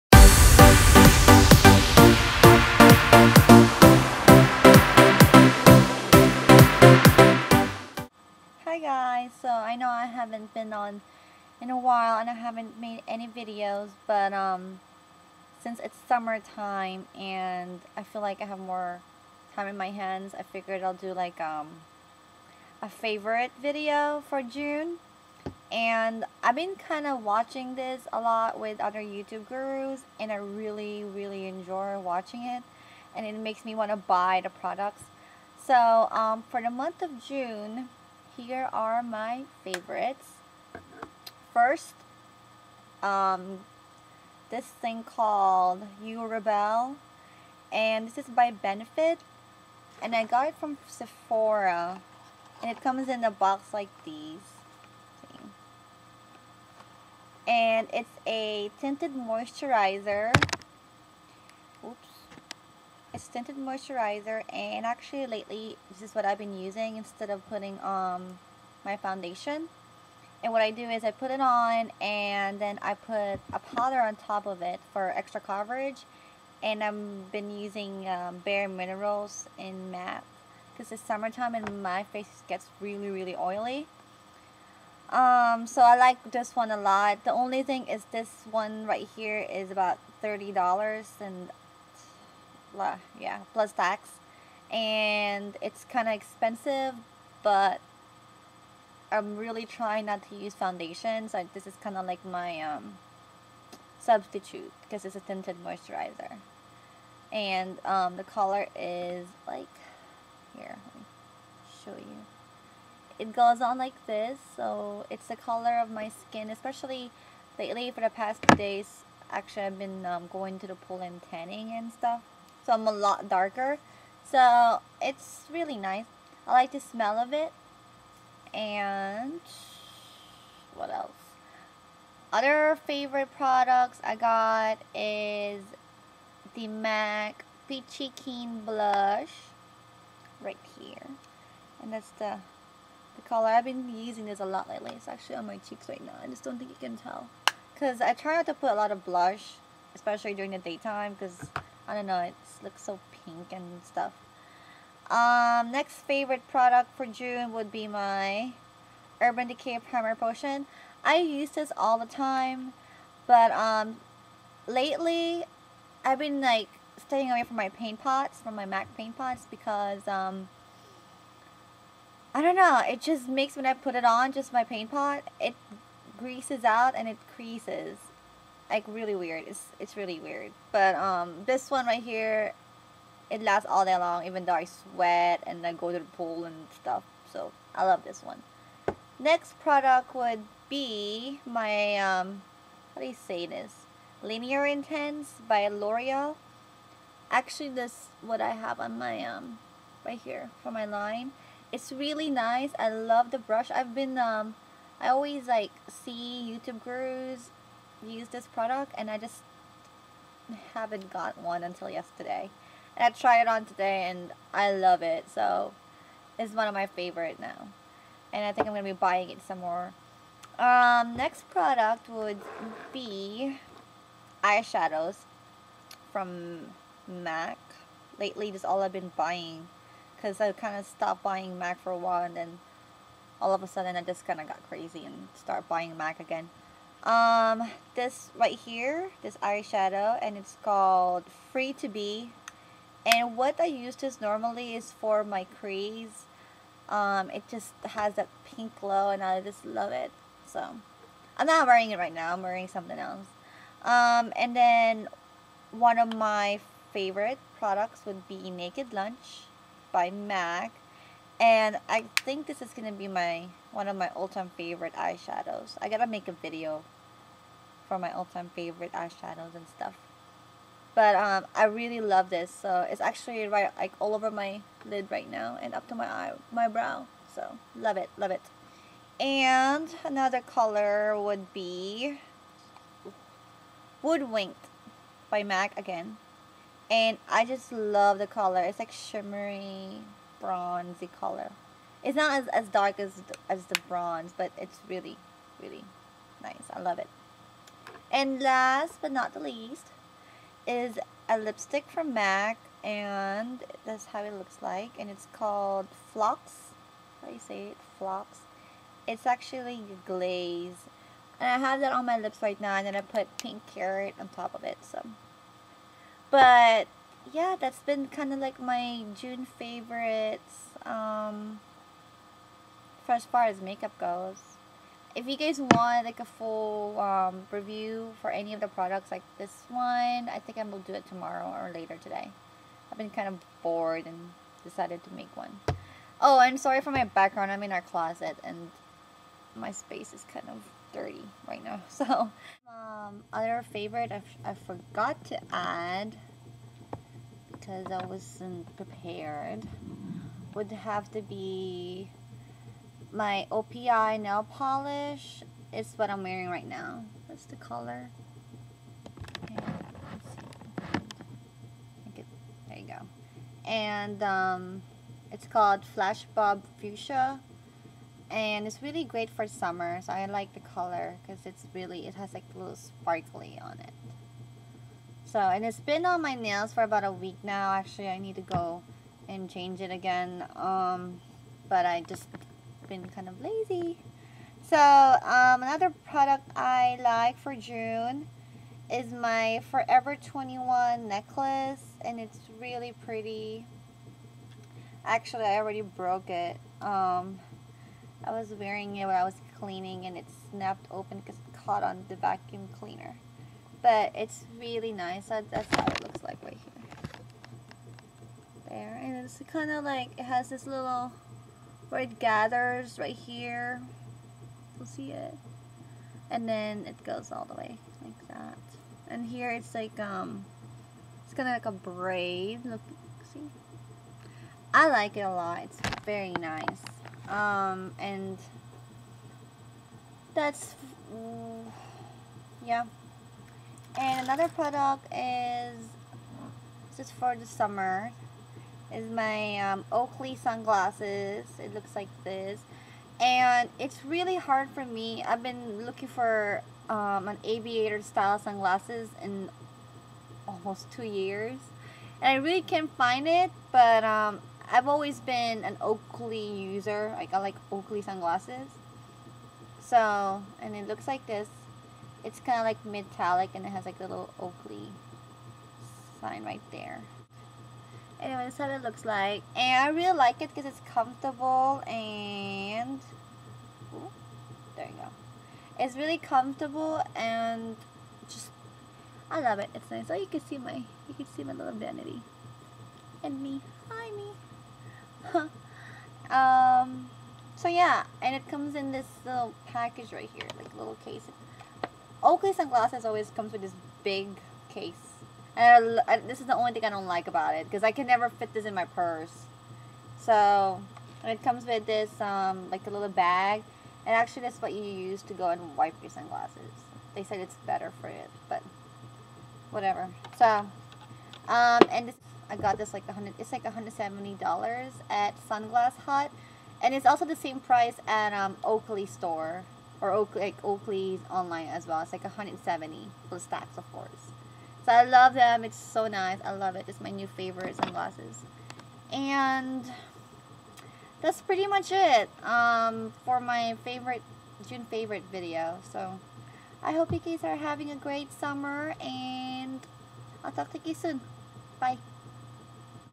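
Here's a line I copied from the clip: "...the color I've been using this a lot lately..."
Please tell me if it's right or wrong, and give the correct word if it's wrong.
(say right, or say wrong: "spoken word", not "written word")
right.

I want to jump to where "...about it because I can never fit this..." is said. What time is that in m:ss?
8:17.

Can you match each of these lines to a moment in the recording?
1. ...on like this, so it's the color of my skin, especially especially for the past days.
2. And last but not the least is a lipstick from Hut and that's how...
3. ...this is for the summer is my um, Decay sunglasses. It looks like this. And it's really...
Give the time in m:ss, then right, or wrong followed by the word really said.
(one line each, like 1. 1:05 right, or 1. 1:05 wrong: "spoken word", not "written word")
1. 1:53 wrong: "lately", not "especially"
2. 4:58 wrong: "MAC", not "Hut"
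3. 7:16 wrong: "Oakley", not "Decay".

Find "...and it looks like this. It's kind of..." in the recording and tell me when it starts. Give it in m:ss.
7:40.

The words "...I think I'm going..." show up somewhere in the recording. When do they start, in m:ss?
3:38.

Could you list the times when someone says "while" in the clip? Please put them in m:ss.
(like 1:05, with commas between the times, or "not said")
0:11, 3:51.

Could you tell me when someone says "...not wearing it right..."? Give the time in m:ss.
4:11.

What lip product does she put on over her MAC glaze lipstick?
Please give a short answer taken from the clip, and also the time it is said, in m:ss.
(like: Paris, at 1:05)
Pink Carrot, at 5:13.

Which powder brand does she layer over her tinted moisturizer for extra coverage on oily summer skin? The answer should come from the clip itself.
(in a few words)
Bare Minerals.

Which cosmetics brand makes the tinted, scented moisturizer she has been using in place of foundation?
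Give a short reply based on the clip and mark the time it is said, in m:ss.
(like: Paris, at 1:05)
Benefit, at 0:48.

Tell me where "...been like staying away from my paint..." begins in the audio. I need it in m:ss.
2:46.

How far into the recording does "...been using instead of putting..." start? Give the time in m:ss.
1:06.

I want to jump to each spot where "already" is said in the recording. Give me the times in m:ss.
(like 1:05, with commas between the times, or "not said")
6:35.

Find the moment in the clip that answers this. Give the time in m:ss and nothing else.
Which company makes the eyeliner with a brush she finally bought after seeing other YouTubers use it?
3:15.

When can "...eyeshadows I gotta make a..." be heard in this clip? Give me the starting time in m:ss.
4:24.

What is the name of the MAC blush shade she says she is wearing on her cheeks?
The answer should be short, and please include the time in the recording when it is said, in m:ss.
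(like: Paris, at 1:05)
Peachy Keen, at 2:17.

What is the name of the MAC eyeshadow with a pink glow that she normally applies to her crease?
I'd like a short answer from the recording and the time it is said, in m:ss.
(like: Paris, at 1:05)
Free to Be, at 4:01.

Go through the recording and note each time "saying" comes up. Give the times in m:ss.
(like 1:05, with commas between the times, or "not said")
not said.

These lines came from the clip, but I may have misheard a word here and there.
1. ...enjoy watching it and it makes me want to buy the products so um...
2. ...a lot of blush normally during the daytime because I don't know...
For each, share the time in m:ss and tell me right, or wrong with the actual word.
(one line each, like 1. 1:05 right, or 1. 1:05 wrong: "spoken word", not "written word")
1. 0:31 right
2. 2:28 wrong: "especially", not "normally".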